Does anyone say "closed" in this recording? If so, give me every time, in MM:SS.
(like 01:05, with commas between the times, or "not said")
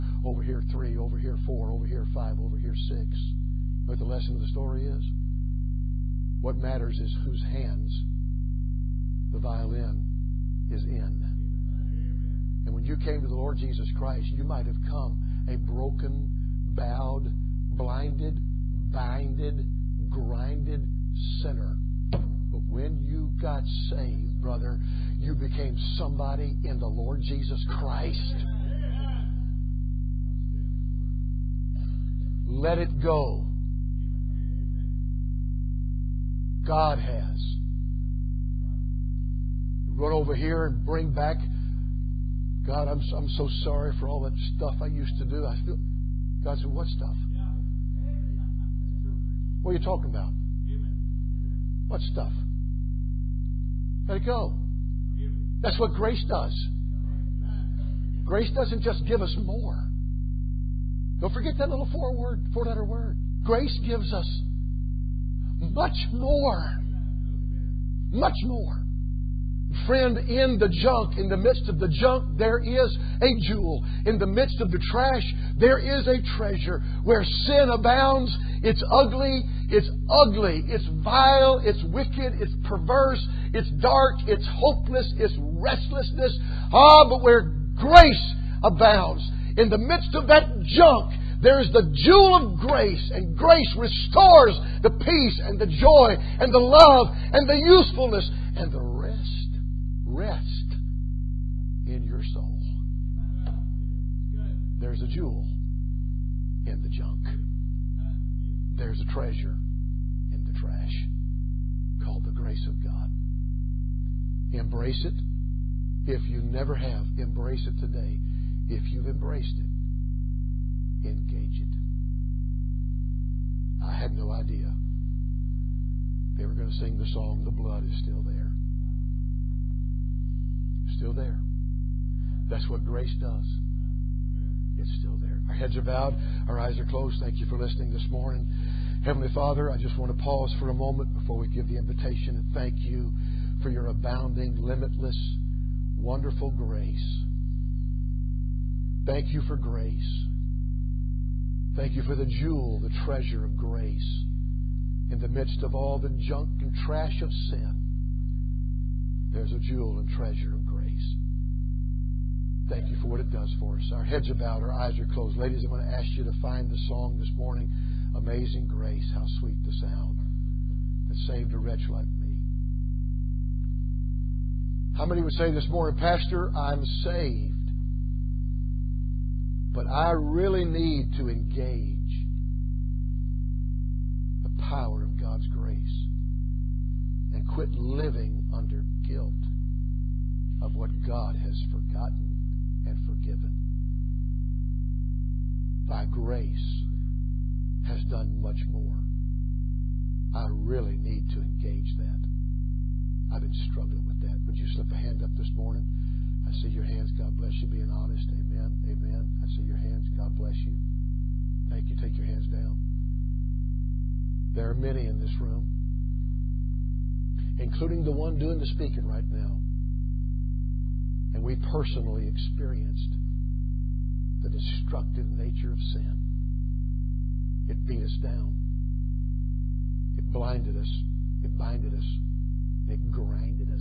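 02:16, 02:45.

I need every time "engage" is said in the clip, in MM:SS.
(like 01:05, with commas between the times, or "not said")
02:01, 03:01, 03:21.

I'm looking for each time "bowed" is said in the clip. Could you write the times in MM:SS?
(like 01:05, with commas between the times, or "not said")
00:16, 02:15, 02:44.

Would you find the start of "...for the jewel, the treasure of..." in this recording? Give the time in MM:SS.
02:32.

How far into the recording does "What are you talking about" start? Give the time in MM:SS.
00:49.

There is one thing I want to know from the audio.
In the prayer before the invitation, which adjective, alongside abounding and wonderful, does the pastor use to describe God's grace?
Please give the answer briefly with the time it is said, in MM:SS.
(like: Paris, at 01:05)
limitless, at 02:24.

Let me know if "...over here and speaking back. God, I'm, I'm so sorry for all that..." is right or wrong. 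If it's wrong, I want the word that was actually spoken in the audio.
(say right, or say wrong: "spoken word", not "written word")
wrong: "bring", not "speaking".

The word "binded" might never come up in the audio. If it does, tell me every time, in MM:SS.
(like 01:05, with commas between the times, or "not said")
00:18, 03:51.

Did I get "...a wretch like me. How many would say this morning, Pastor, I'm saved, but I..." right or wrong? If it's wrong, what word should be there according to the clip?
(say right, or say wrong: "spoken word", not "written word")
right.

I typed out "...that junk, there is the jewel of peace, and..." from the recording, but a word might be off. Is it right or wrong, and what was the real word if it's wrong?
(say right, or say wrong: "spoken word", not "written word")
wrong: "grace", not "peace".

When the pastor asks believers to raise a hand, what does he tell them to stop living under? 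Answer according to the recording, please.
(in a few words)
guilt.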